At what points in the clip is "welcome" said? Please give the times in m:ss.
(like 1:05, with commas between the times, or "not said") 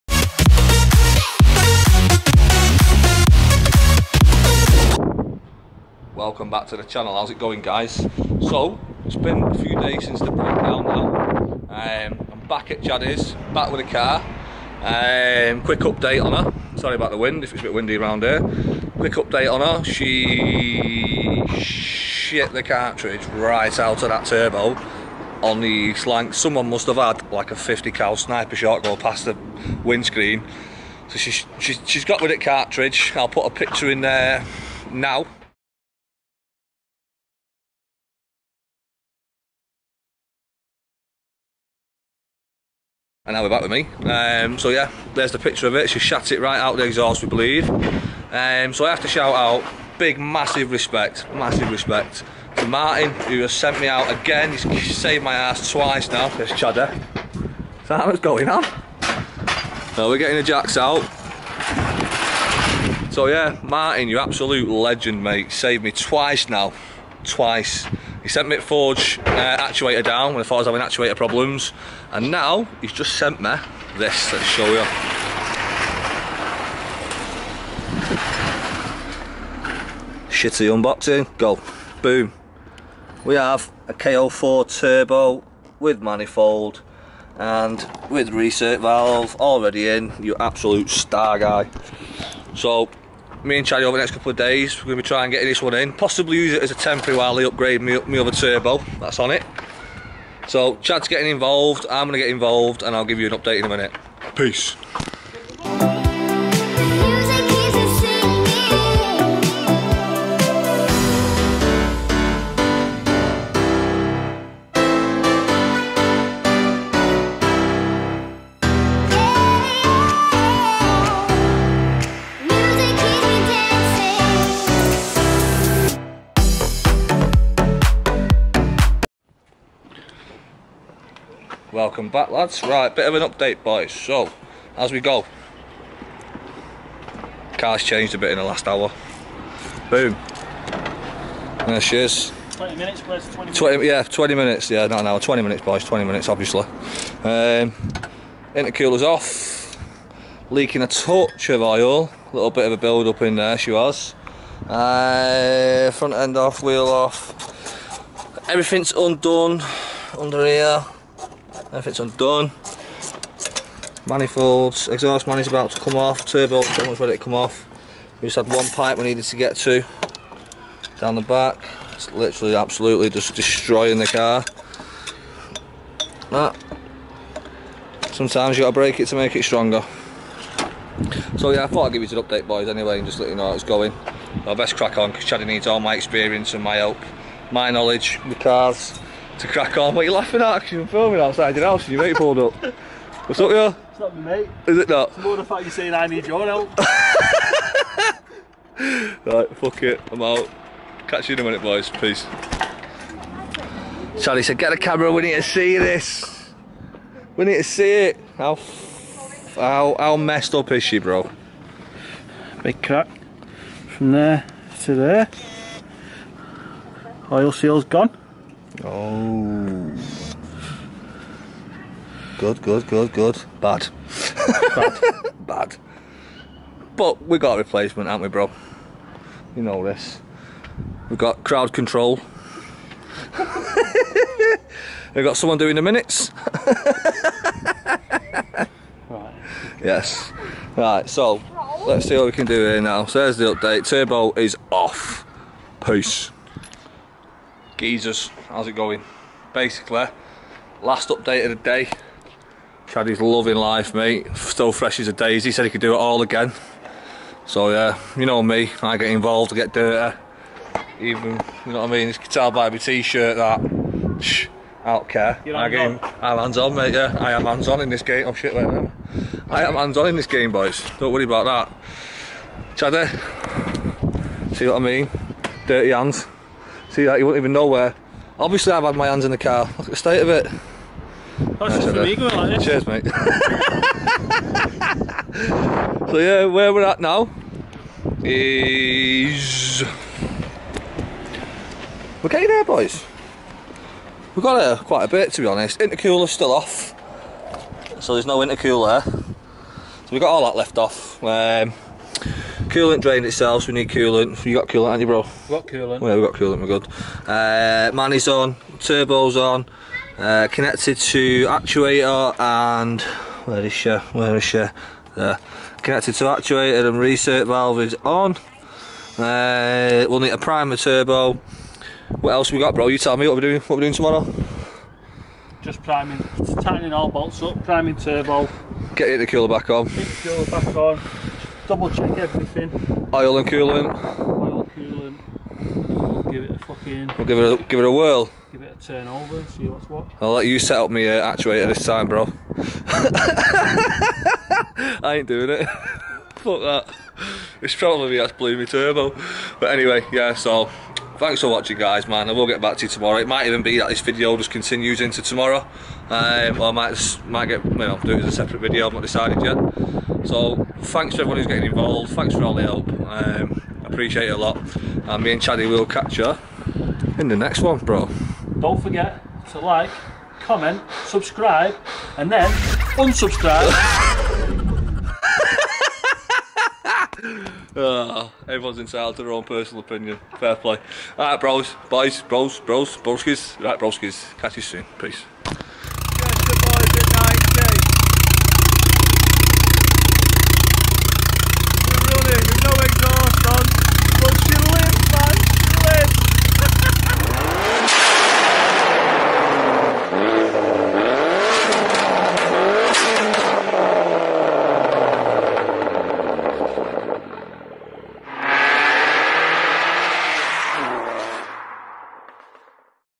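0:06, 2:11.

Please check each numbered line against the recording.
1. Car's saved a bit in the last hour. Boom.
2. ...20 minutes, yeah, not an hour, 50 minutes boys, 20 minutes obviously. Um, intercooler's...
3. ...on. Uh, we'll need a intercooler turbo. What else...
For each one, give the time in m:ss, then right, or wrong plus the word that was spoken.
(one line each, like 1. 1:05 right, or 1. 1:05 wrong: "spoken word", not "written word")
1. 2:17 wrong: "changed", not "saved"
2. 2:24 wrong: "20", not "50"
3. 5:18 wrong: "primer", not "intercooler".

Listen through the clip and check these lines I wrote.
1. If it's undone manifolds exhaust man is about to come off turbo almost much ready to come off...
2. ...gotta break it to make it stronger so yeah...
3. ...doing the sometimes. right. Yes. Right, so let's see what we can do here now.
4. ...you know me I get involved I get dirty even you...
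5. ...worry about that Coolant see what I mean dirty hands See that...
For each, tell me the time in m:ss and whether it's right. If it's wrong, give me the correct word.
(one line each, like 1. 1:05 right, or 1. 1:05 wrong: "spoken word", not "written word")
1. 2:41 right
2. 2:58 right
3. 3:55 wrong: "minutes", not "sometimes"
4. 4:18 right
5. 4:31 wrong: "Chaddy", not "Coolant".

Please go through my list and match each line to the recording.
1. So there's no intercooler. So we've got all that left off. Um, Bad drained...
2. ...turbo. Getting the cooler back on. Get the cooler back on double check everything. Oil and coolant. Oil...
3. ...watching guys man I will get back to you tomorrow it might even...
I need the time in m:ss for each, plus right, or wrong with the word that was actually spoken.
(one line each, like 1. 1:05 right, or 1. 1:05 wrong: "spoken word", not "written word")
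1. 4:58 wrong: "Coolant", not "Bad"
2. 5:27 right
3. 5:51 right.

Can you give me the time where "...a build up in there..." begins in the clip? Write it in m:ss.
2:32.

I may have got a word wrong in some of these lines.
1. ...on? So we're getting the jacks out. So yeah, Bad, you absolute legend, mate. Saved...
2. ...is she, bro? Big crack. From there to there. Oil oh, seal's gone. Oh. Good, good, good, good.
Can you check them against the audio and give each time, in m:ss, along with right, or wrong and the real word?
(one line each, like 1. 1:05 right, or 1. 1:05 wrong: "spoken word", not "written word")
1. 0:58 wrong: "Martin", not "Bad"
2. 3:30 right.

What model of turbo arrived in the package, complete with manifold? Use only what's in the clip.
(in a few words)
K04.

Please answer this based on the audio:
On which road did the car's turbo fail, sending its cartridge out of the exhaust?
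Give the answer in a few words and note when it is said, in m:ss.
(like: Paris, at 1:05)
East Lancs, at 0:25.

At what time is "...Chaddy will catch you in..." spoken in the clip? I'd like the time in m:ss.
6:05.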